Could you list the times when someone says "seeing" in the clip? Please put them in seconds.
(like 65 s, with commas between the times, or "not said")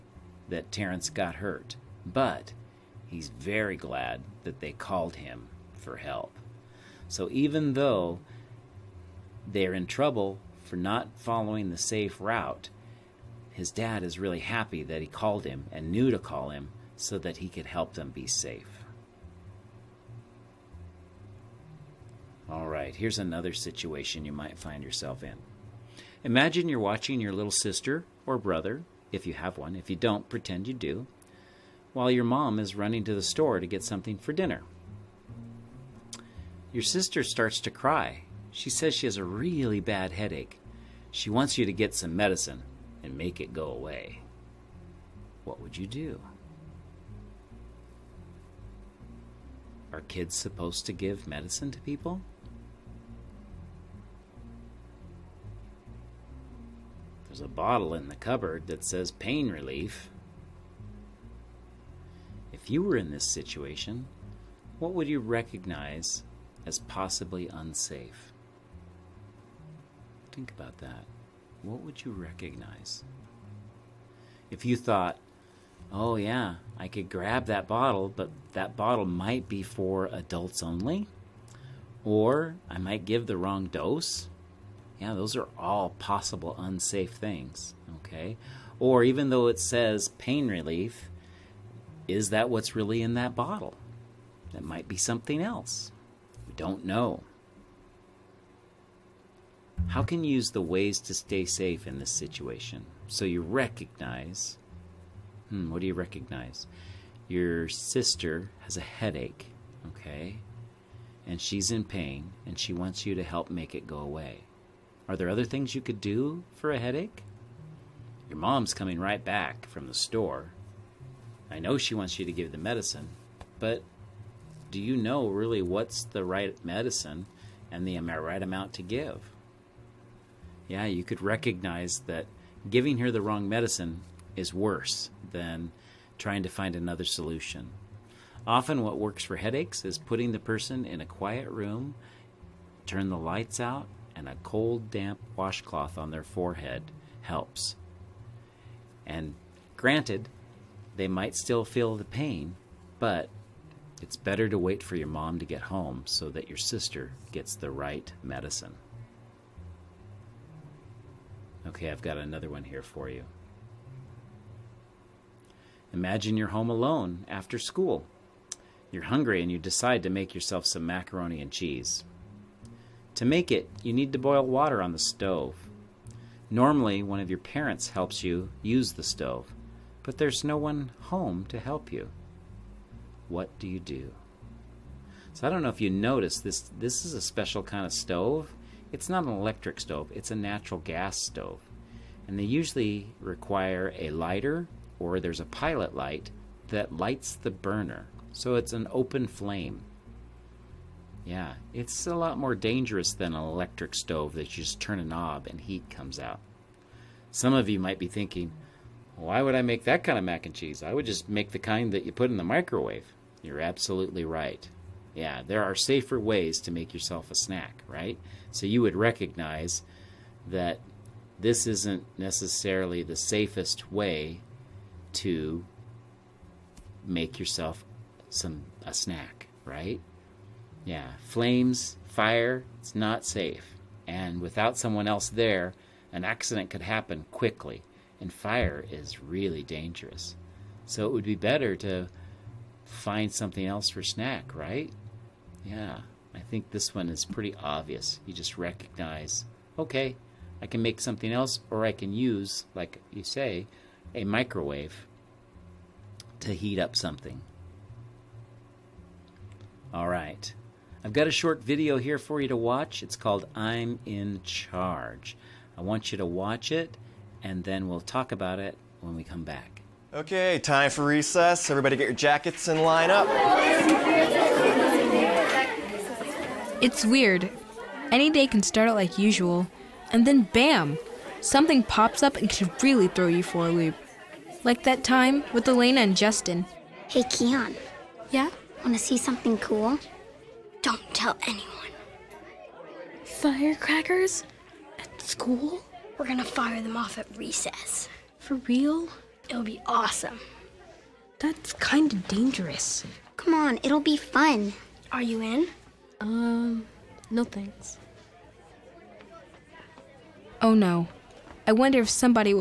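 not said.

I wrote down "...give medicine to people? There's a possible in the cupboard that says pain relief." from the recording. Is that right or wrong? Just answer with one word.
wrong.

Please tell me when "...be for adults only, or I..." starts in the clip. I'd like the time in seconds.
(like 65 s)
79 s.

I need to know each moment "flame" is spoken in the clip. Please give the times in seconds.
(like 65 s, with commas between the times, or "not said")
199 s, 231 s.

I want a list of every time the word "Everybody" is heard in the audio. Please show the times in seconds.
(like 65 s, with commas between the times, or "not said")
271 s.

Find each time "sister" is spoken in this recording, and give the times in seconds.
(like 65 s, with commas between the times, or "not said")
27 s, 36 s, 107 s, 156 s.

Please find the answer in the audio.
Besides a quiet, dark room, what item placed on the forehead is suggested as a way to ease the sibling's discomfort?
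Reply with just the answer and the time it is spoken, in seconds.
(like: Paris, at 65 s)
cold, damp washcloth, at 144 s.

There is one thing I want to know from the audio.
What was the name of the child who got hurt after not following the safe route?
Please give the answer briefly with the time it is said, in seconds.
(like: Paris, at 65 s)
Terrence, at 0 s.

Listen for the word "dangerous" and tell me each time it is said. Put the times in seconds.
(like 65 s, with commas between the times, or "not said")
202 s, 239 s, 302 s.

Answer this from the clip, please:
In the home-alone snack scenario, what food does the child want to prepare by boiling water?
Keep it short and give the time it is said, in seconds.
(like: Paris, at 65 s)
macaroni and cheese, at 170 s.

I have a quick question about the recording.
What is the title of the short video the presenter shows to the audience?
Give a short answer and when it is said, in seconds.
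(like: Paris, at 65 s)
I'm in Charge, at 263 s.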